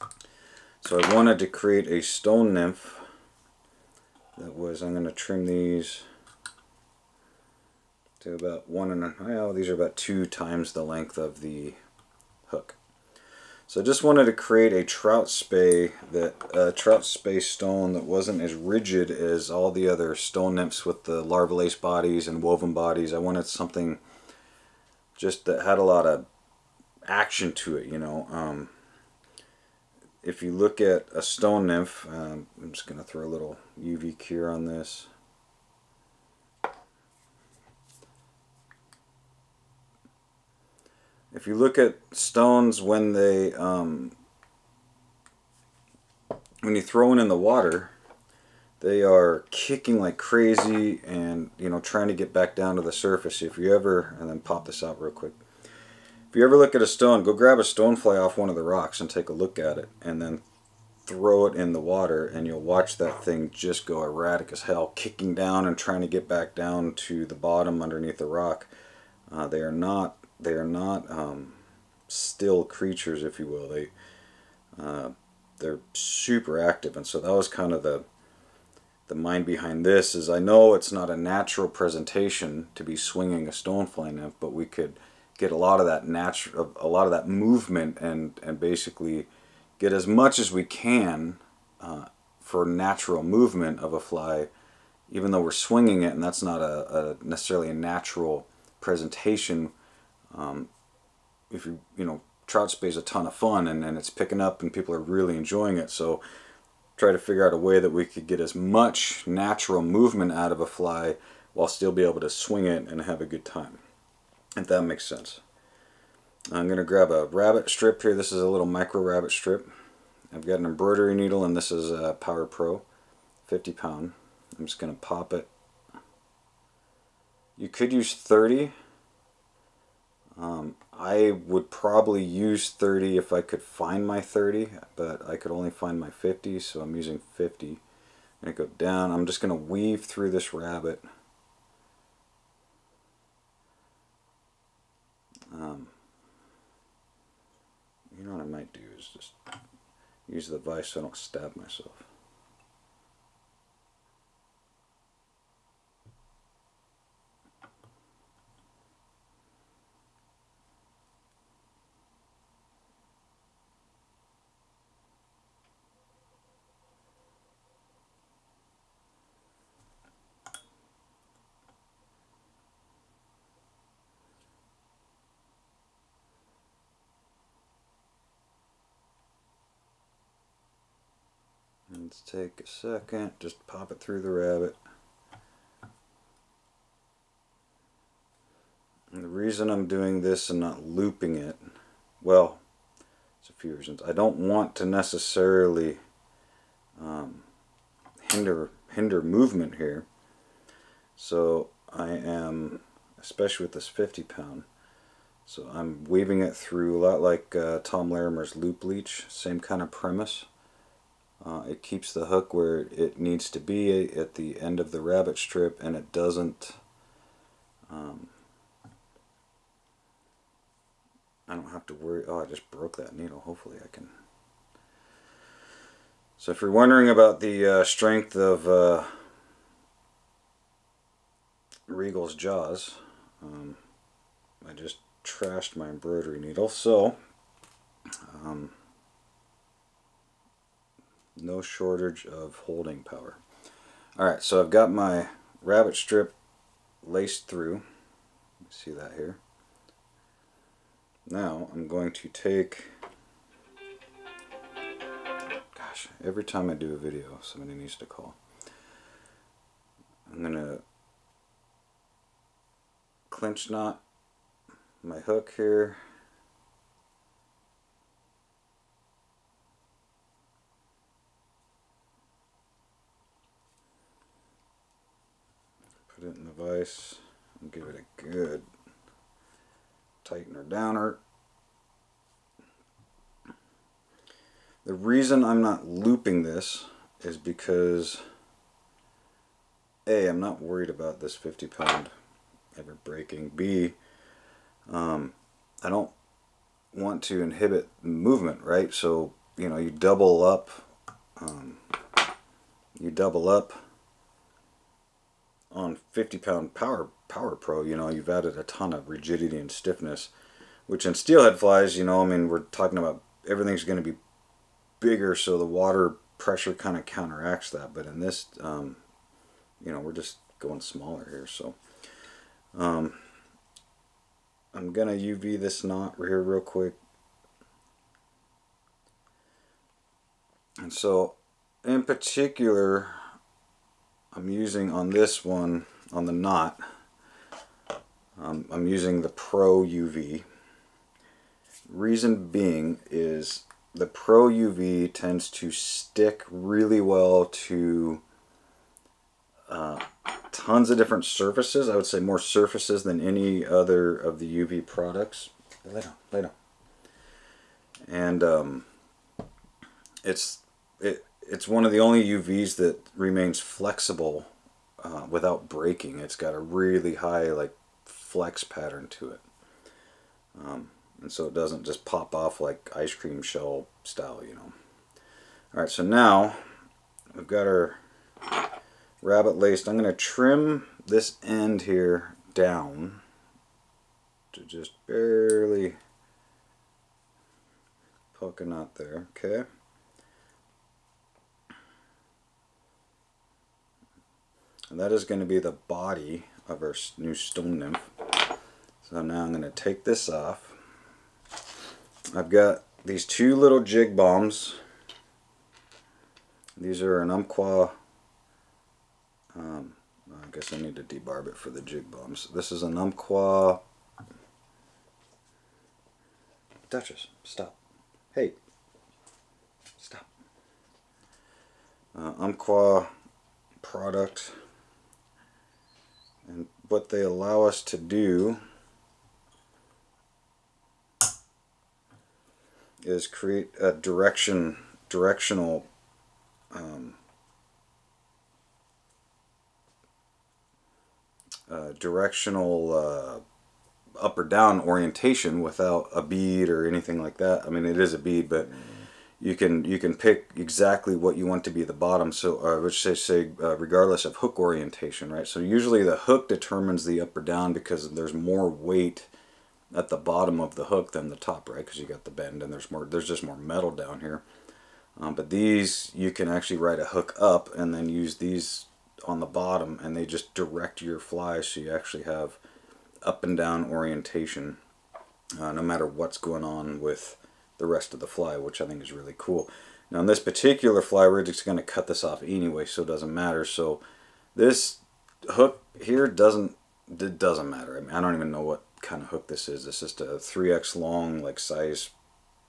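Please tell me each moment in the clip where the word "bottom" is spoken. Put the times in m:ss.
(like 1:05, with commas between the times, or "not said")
1:07, 7:31, 7:40, 7:49.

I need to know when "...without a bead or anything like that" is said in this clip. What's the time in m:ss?
7:25.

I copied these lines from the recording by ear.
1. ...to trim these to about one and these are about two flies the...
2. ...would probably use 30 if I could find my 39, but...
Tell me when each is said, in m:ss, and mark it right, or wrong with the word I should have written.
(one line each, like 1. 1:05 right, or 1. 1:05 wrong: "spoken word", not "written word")
1. 0:05 wrong: "times", not "flies"
2. 2:11 wrong: "30", not "39".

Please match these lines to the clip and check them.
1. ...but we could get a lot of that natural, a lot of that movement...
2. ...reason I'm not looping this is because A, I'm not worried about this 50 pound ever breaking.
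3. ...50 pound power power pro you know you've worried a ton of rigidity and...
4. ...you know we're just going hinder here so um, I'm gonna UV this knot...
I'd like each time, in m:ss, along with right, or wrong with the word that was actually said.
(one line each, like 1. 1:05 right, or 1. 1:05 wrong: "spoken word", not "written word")
1. 1:24 right
2. 4:44 right
3. 5:06 wrong: "added", not "worried"
4. 5:19 wrong: "smaller", not "hinder".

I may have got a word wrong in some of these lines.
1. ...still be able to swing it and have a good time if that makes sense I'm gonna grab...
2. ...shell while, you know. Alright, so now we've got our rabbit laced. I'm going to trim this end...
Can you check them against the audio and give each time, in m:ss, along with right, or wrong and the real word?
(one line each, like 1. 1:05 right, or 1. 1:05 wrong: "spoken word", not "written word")
1. 1:51 right
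2. 6:13 wrong: "style", not "while".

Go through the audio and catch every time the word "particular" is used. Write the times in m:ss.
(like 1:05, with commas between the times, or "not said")
5:32, 8:00.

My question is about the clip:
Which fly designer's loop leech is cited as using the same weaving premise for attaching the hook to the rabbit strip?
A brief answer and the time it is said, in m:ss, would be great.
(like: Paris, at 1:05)
Tom Larimer, at 3:27.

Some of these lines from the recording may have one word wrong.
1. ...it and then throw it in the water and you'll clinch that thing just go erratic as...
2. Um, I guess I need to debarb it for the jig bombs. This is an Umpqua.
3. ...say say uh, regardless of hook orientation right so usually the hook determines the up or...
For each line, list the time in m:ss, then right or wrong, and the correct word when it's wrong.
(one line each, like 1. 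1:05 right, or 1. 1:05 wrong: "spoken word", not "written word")
1. 0:59 wrong: "watch", not "clinch"
2. 6:49 right
3. 7:33 right.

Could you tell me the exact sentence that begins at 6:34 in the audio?
And that is going to be the body of our new stone nymph.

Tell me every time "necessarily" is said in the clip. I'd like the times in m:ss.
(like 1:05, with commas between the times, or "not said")
1:37, 3:14.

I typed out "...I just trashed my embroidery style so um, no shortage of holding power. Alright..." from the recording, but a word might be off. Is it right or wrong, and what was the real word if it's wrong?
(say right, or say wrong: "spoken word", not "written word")
wrong: "needle", not "style".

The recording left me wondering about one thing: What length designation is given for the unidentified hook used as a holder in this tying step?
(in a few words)
3X long.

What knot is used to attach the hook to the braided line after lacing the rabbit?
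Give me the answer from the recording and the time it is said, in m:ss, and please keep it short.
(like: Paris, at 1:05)
clinch knot, at 4:23.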